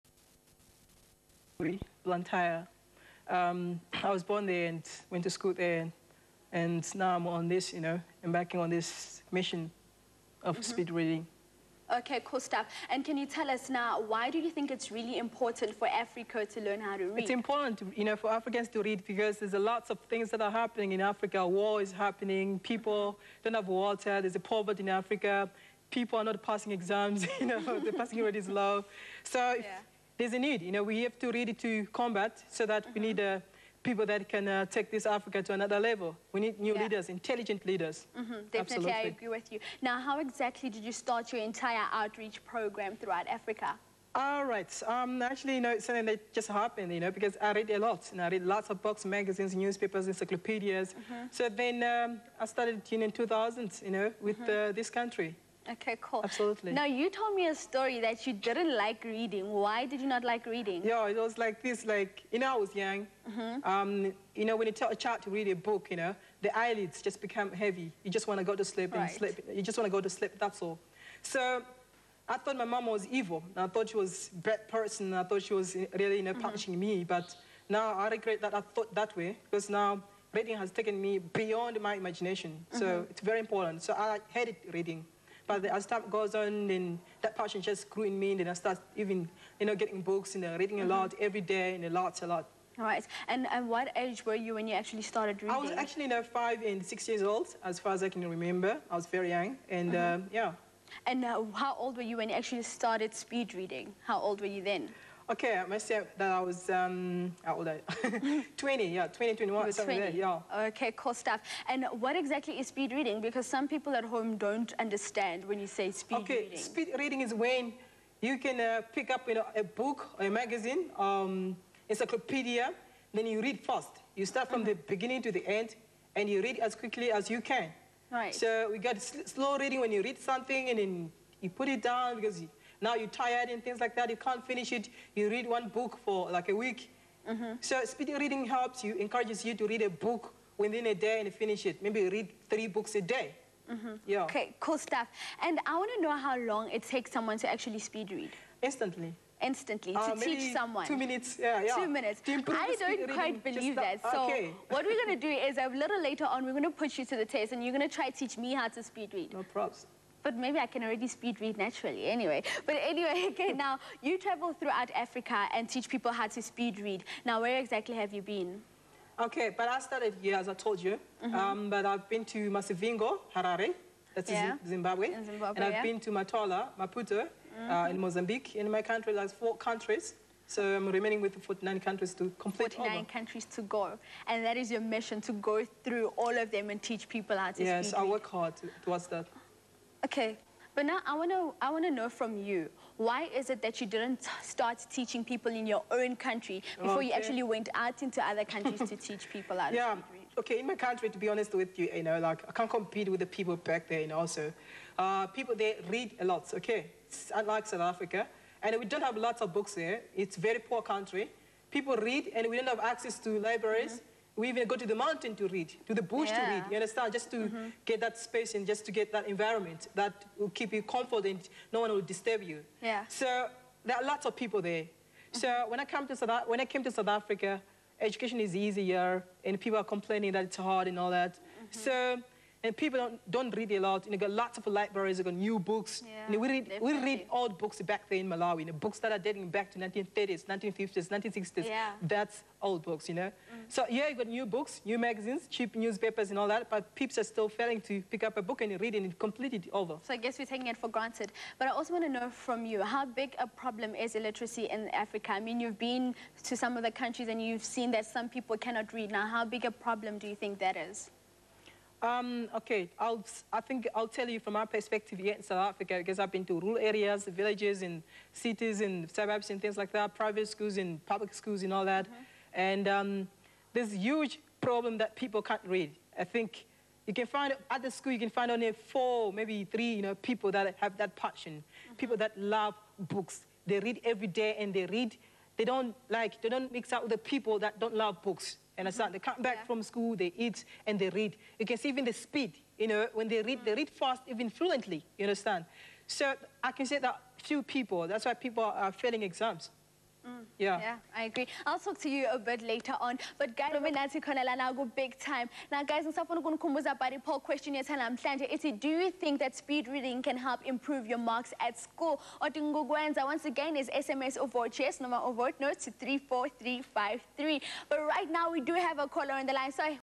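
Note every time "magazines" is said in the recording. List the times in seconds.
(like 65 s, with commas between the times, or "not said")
49 s, 120 s, 244 s.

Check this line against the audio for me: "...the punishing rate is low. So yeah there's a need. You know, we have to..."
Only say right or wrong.
wrong.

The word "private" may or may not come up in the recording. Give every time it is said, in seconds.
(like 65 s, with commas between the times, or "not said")
270 s.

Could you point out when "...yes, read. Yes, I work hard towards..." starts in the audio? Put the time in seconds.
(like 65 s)
187 s.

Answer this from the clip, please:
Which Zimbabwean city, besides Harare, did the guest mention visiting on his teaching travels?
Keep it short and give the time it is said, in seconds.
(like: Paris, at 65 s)
Masivingo, at 172 s.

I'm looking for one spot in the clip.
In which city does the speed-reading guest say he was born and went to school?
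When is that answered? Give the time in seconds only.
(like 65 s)
2 s.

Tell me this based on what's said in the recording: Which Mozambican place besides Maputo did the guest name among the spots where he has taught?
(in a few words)
Matola.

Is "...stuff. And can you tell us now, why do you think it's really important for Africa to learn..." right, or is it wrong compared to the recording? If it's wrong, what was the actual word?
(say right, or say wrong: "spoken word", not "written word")
right.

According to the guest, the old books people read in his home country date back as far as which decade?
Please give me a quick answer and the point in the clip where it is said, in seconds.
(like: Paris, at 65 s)
1930s, at 239 s.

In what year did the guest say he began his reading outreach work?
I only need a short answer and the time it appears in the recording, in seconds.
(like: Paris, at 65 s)
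2000, at 53 s.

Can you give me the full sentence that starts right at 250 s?
So I guess we're taking it for granted.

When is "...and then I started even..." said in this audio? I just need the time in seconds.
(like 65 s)
88 s.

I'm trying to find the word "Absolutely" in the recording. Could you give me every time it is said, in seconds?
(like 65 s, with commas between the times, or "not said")
38 s, 56 s.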